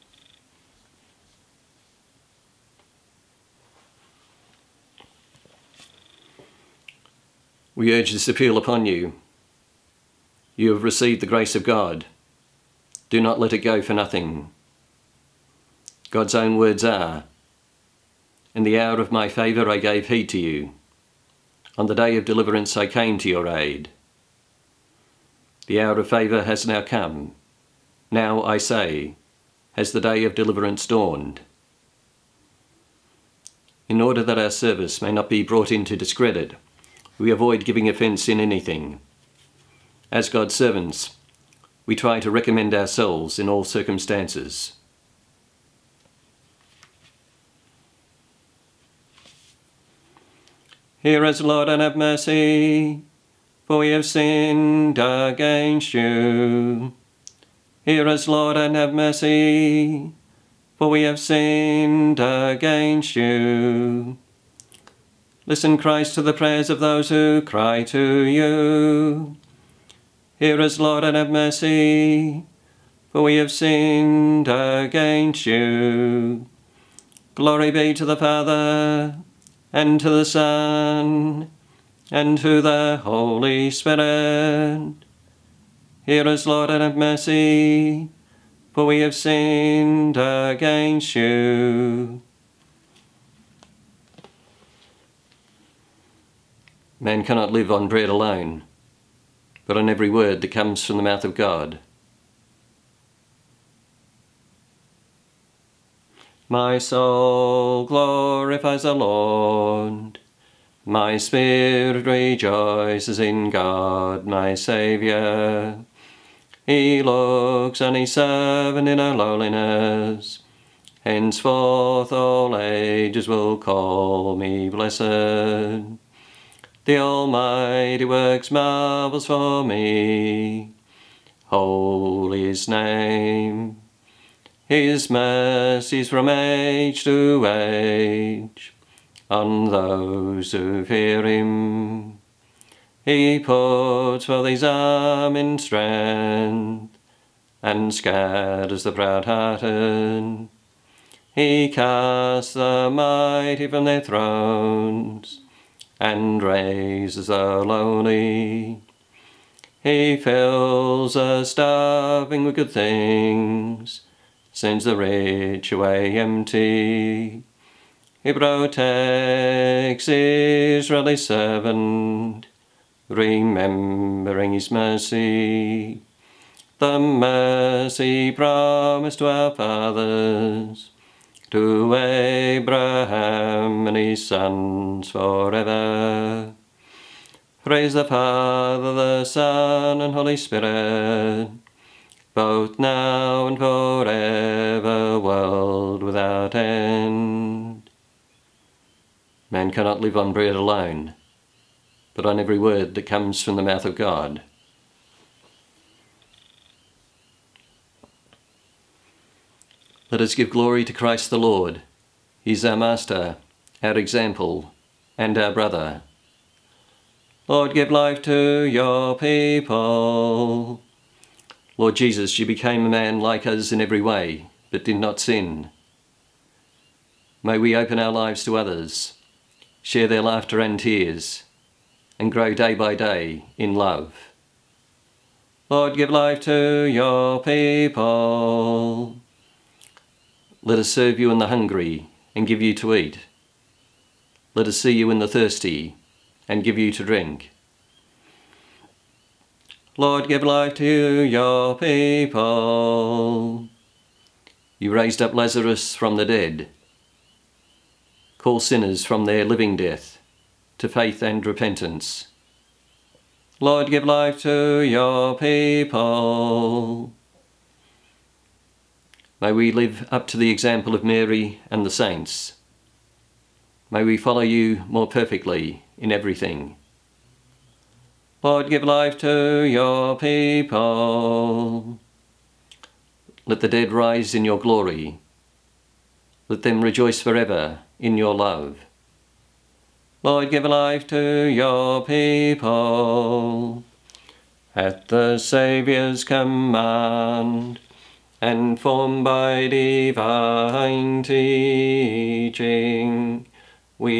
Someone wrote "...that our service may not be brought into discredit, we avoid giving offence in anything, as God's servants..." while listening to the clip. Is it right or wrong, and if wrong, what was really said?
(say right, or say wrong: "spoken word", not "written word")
right.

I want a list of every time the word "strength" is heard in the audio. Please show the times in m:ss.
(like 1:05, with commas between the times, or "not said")
2:25.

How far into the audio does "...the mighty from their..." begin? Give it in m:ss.
2:32.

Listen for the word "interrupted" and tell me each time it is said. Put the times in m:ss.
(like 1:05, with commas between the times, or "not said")
not said.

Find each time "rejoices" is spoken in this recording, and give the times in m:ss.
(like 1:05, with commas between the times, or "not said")
1:52, 4:46.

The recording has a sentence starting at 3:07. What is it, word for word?
Praise the Father, the Son, and Holy Spirit, both now and forever, world without end.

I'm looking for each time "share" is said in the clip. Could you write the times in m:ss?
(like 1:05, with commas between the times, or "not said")
3:49.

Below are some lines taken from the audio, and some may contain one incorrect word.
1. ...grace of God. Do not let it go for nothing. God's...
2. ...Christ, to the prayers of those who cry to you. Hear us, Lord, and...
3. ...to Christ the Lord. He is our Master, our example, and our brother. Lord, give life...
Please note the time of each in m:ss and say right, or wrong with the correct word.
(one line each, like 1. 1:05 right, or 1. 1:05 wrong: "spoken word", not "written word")
1. 0:11 right
2. 1:05 right
3. 3:30 right.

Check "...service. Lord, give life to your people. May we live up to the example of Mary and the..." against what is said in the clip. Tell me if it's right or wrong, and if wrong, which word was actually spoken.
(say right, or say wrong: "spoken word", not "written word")
wrong: "repentance", not "service".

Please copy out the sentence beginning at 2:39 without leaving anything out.
He fills the starving with good things, sends the rich away empty.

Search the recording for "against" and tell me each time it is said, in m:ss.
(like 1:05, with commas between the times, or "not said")
0:54, 1:02, 1:14, 1:30.